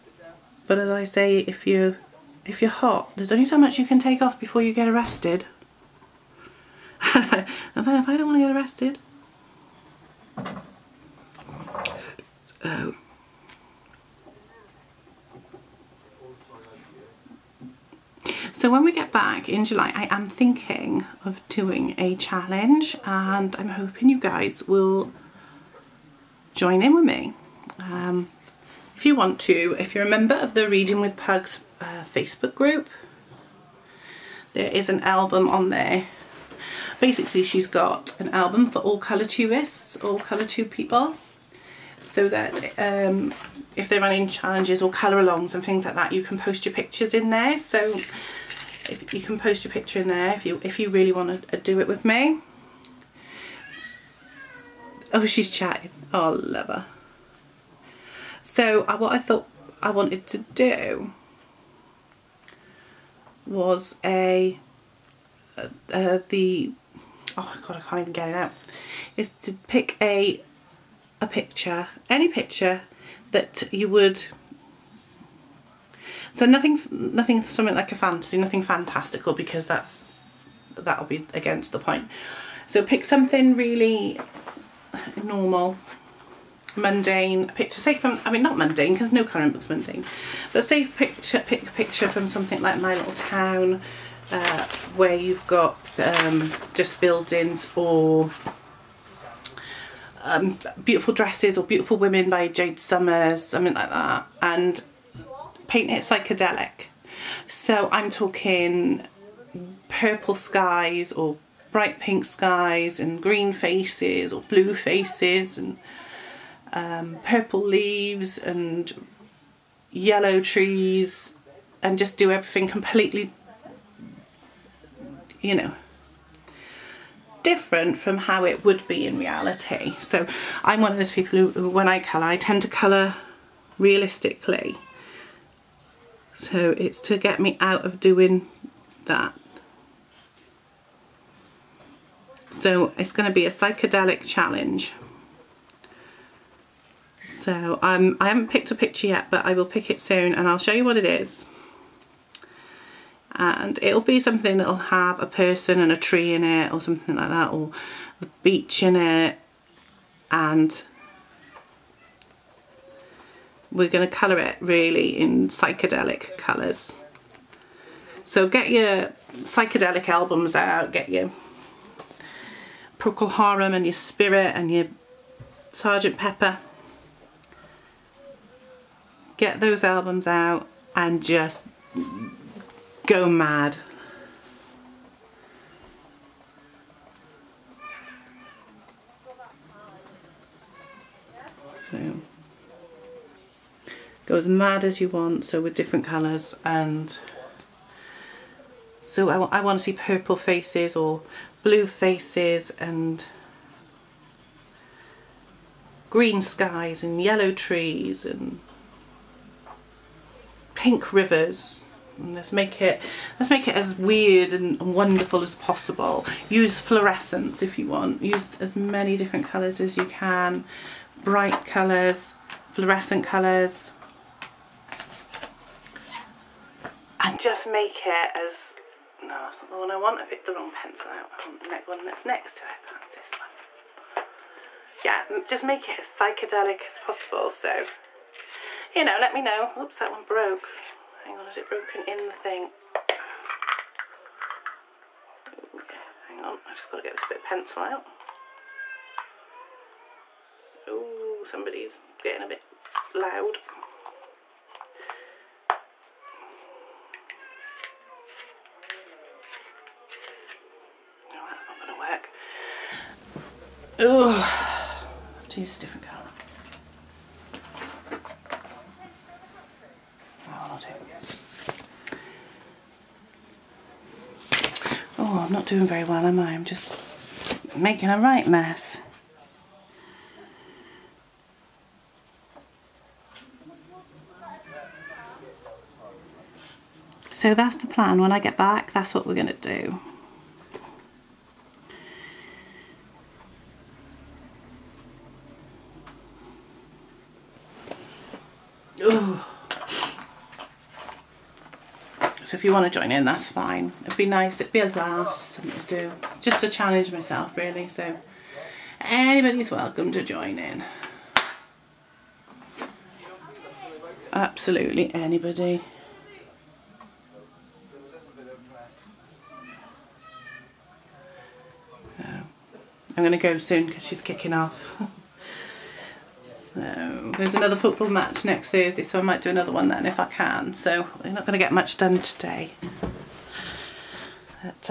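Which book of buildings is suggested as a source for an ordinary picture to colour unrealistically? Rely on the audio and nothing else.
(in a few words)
My Little Town.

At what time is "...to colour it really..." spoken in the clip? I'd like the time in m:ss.
2:44.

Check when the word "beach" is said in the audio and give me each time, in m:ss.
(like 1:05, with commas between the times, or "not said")
2:38.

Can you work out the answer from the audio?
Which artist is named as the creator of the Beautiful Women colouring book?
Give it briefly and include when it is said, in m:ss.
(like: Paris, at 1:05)
Jade Summers, at 1:42.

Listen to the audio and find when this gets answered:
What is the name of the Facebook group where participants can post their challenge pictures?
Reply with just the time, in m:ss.
0:30.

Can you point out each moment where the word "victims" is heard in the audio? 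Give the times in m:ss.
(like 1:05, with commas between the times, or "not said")
not said.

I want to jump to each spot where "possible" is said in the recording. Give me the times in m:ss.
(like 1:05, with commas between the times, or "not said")
3:35, 3:56.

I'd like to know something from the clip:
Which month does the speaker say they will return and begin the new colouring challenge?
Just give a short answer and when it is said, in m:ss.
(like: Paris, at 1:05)
July, at 0:19.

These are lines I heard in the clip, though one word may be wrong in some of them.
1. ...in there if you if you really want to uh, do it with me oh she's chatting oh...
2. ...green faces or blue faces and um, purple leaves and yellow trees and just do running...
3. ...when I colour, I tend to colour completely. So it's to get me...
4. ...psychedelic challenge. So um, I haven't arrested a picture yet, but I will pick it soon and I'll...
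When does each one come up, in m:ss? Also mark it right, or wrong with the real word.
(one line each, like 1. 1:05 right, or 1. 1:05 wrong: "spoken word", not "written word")
1. 0:50 right
2. 1:53 wrong: "everything", not "running"
3. 2:11 wrong: "realistically", not "completely"
4. 2:23 wrong: "picked", not "arrested".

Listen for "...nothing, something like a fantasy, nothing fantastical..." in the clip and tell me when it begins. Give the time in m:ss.
1:16.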